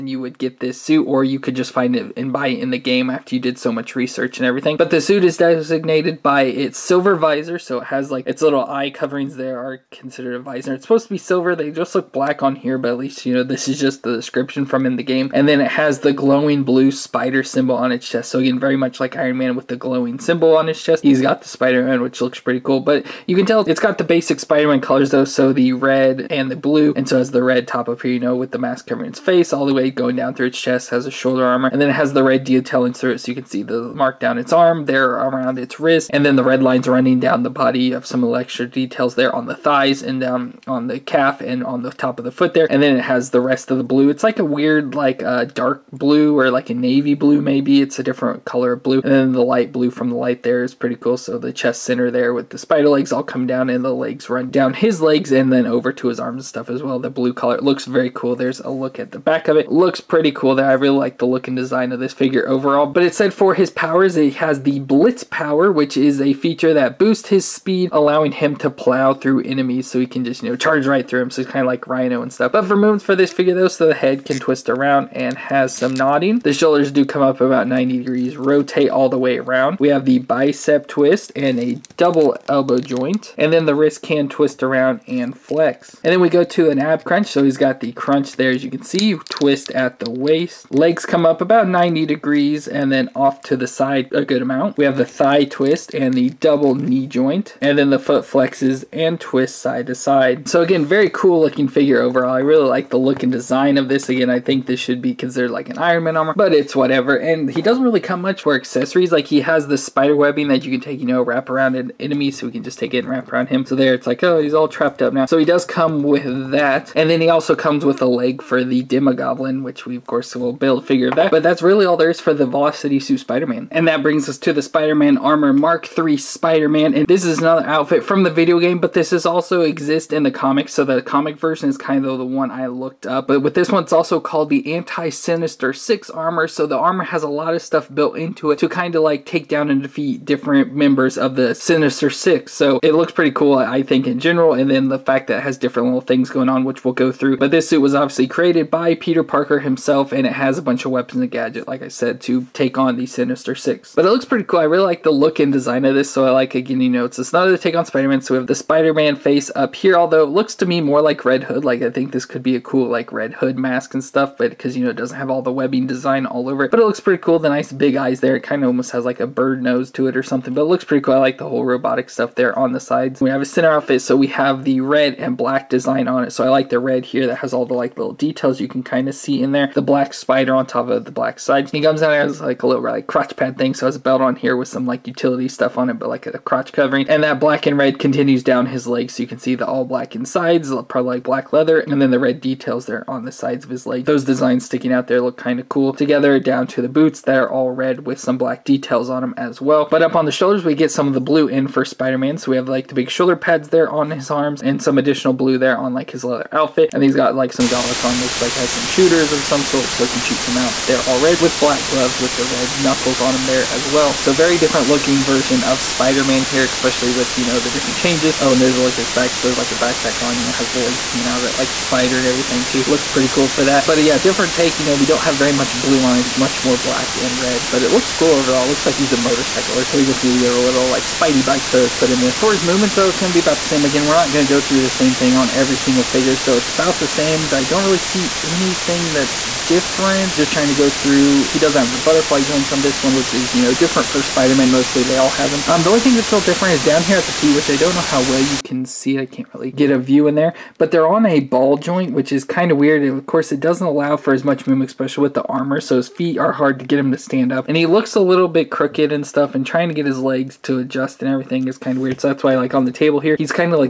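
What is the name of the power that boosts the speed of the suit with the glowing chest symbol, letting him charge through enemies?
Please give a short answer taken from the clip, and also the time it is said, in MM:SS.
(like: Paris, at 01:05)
Blitz, at 01:04.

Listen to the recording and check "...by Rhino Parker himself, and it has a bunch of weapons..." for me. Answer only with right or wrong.
wrong.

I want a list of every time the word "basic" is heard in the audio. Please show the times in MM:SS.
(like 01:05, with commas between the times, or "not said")
00:24.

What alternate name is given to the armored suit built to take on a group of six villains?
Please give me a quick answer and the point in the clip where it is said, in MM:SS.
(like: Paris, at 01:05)
Anti-Sinister 6 Armor, at 02:14.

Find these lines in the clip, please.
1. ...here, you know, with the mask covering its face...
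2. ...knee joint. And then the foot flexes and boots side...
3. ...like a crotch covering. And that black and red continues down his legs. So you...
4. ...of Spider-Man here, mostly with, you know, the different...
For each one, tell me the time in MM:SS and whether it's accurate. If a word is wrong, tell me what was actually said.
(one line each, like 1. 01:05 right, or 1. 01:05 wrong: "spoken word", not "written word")
1. 00:28 right
2. 01:36 wrong: "twists", not "boots"
3. 03:06 right
4. 03:35 wrong: "especially", not "mostly".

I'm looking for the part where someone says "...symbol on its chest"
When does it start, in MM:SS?
00:17.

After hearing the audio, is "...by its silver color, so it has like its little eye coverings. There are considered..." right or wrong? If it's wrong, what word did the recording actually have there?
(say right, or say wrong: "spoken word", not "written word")
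wrong: "visor", not "color".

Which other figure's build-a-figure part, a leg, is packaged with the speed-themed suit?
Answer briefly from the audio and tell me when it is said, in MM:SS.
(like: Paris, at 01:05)
Demogoblin, at 01:58.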